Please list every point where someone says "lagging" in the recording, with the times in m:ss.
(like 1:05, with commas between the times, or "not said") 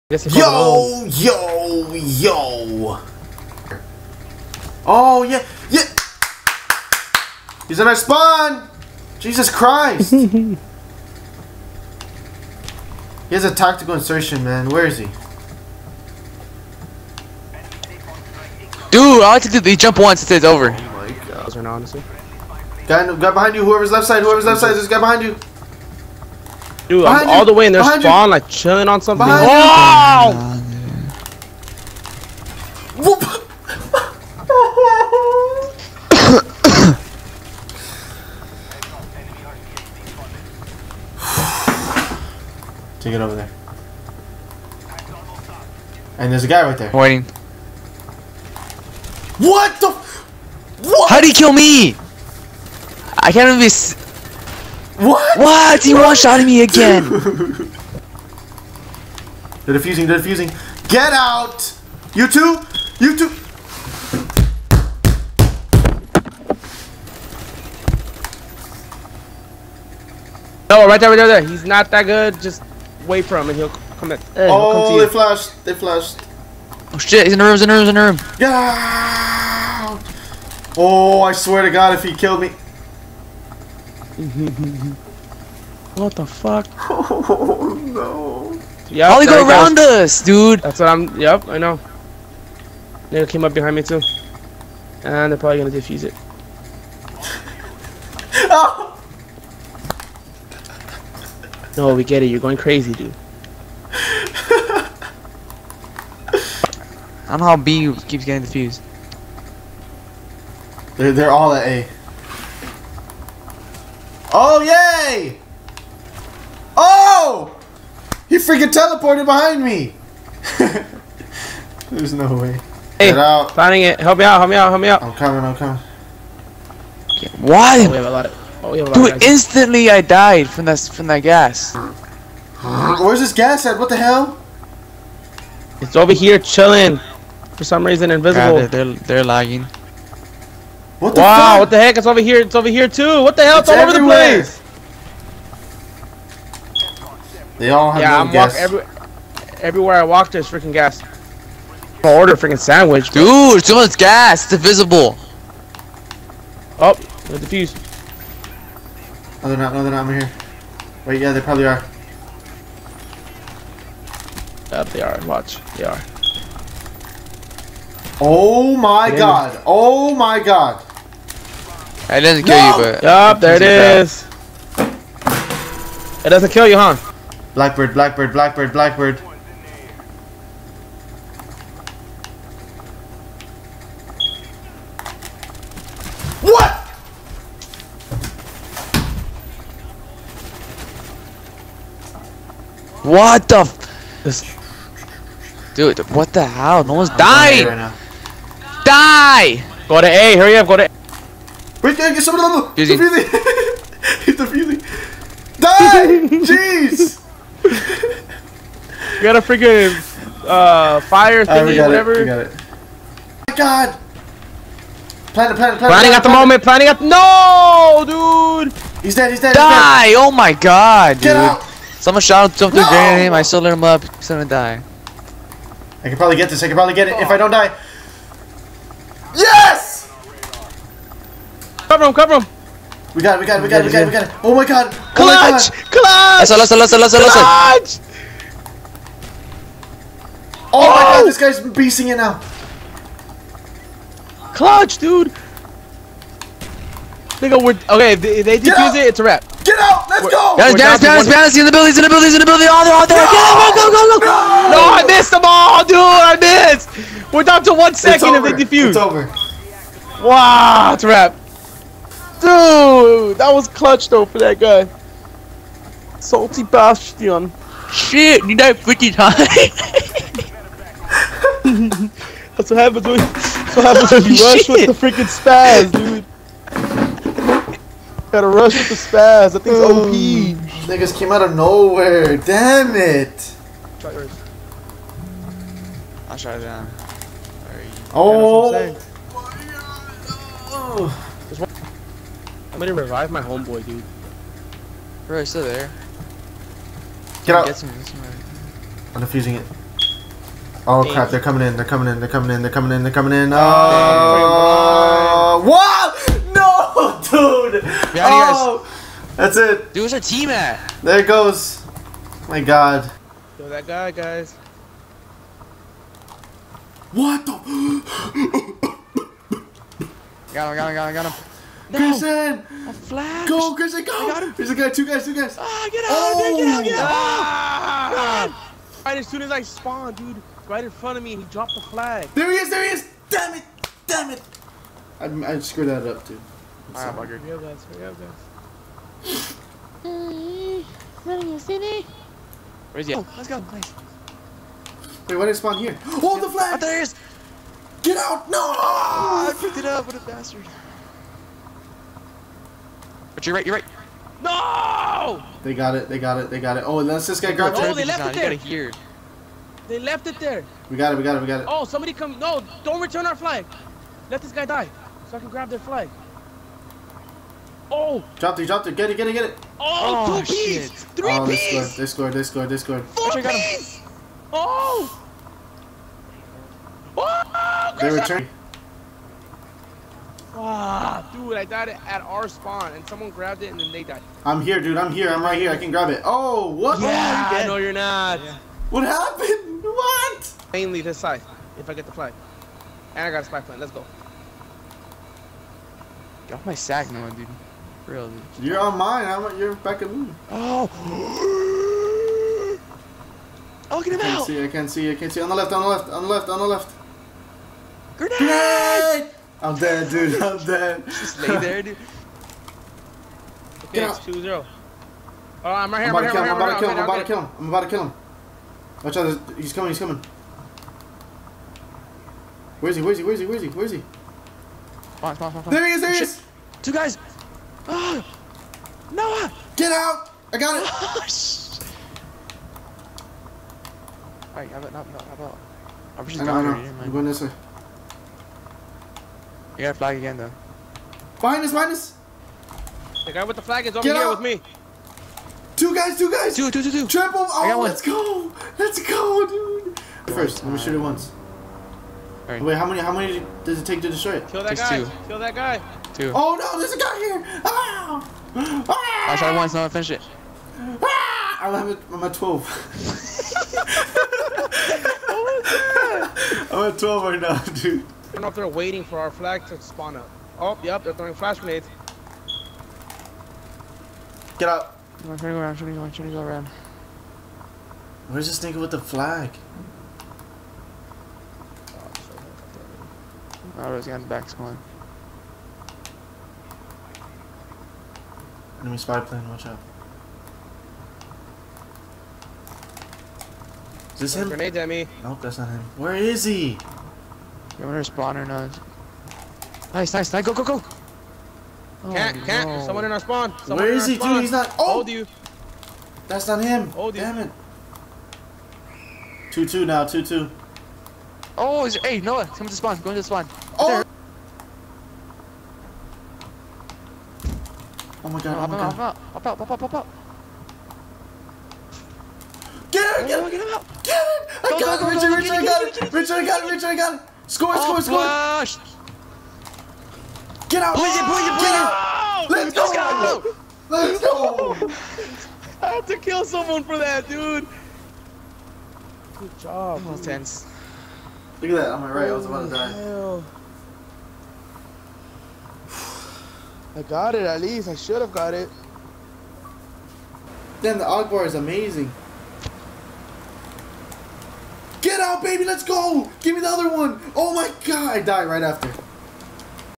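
2:19.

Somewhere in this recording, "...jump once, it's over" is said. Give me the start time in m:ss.
0:19.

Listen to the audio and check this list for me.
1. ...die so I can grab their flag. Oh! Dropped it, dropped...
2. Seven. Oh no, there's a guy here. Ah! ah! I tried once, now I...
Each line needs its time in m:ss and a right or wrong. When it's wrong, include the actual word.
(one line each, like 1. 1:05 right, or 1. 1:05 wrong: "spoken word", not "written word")
1. 6:04 right
2. 7:36 wrong: "Two", not "Seven".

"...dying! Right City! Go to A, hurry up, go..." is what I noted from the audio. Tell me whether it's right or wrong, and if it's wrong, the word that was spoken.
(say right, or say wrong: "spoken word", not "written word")
wrong: "Die", not "City".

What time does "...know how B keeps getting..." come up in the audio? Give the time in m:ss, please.
1:47.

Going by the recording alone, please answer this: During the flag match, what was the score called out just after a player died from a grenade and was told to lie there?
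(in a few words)
2 0.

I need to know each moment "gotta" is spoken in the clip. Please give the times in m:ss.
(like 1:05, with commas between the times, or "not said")
4:38, 7:19.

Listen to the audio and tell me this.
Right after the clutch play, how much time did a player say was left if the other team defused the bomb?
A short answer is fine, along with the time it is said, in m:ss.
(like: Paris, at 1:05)
1 second, at 4:17.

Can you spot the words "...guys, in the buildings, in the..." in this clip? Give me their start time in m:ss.
4:11.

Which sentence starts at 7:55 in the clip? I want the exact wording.
I'm trying to go around, trying to go trying to go around.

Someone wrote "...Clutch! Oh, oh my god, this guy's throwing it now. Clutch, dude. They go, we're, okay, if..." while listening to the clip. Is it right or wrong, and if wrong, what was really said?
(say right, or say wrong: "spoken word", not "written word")
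wrong: "beasting", not "throwing".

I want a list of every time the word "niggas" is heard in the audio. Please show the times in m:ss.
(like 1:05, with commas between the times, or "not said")
4:40, 7:58.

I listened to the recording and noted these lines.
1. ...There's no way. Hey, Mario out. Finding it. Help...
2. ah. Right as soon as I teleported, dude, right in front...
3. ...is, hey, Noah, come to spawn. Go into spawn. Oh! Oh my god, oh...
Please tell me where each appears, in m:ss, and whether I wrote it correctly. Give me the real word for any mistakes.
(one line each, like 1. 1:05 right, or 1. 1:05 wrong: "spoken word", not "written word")
1. 2:01 wrong: "Get", not "Mario"
2. 5:28 wrong: "spawned", not "teleported"
3. 8:31 right.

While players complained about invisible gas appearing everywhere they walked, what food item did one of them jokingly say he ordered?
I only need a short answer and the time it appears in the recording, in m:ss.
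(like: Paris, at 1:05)
sandwich, at 2:32.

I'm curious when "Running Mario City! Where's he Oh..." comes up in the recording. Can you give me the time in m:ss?
5:40.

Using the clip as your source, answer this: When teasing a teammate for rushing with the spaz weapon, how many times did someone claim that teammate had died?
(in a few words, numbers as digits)
50.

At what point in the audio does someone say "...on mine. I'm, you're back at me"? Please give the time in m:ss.
6:38.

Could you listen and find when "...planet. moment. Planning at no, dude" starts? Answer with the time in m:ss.
3:36.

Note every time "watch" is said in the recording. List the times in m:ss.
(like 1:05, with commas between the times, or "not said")
2:45, 6:59, 8:09.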